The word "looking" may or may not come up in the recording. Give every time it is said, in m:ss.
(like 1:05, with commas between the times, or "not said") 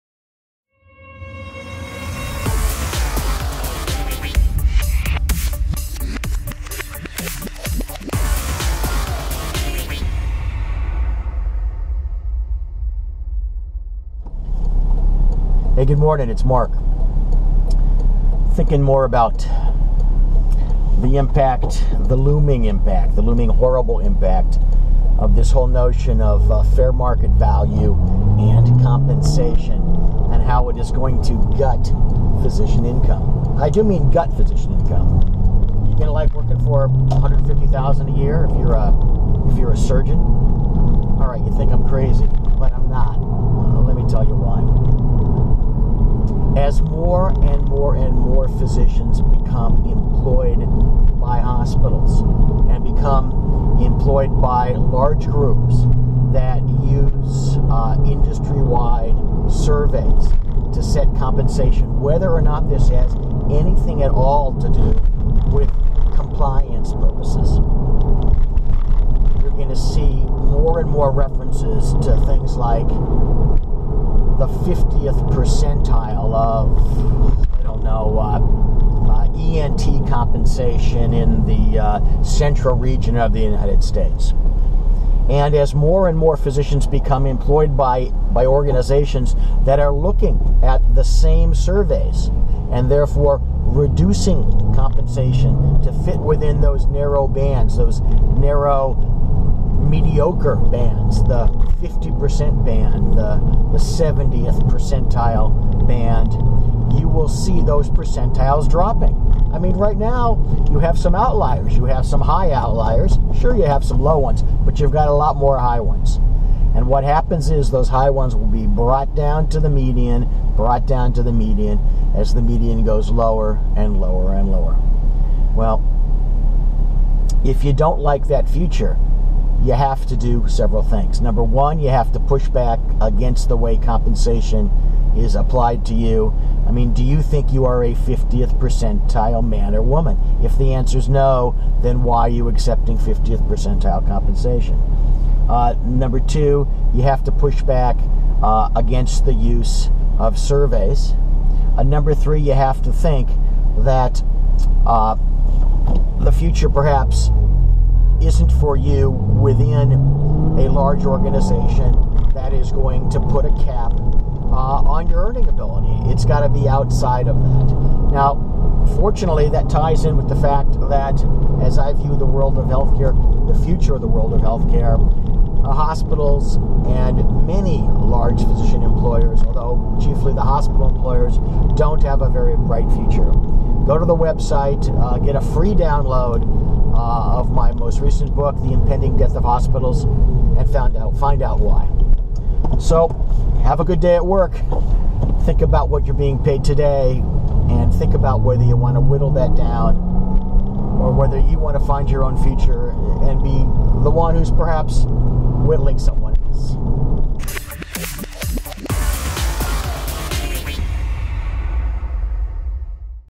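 1:29.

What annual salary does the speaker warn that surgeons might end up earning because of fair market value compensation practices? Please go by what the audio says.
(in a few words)
$150,000.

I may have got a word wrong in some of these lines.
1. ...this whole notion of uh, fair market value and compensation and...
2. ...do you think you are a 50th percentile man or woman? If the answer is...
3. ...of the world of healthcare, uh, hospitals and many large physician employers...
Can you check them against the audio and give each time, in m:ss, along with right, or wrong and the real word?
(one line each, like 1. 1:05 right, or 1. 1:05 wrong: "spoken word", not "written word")
1. 0:25 right
2. 2:16 right
3. 2:53 right.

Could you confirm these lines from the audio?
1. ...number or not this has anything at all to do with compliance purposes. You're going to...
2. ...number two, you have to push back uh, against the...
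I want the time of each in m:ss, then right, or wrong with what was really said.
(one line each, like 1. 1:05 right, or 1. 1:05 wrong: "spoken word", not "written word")
1. 1:01 wrong: "whether", not "number"
2. 2:25 right.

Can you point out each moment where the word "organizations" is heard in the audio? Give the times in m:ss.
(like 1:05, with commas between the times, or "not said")
1:28, 2:41.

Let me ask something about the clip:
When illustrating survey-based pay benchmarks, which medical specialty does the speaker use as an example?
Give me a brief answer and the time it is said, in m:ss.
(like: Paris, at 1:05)
ENT, at 1:19.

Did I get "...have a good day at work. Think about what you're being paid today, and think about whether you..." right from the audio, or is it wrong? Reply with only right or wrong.
right.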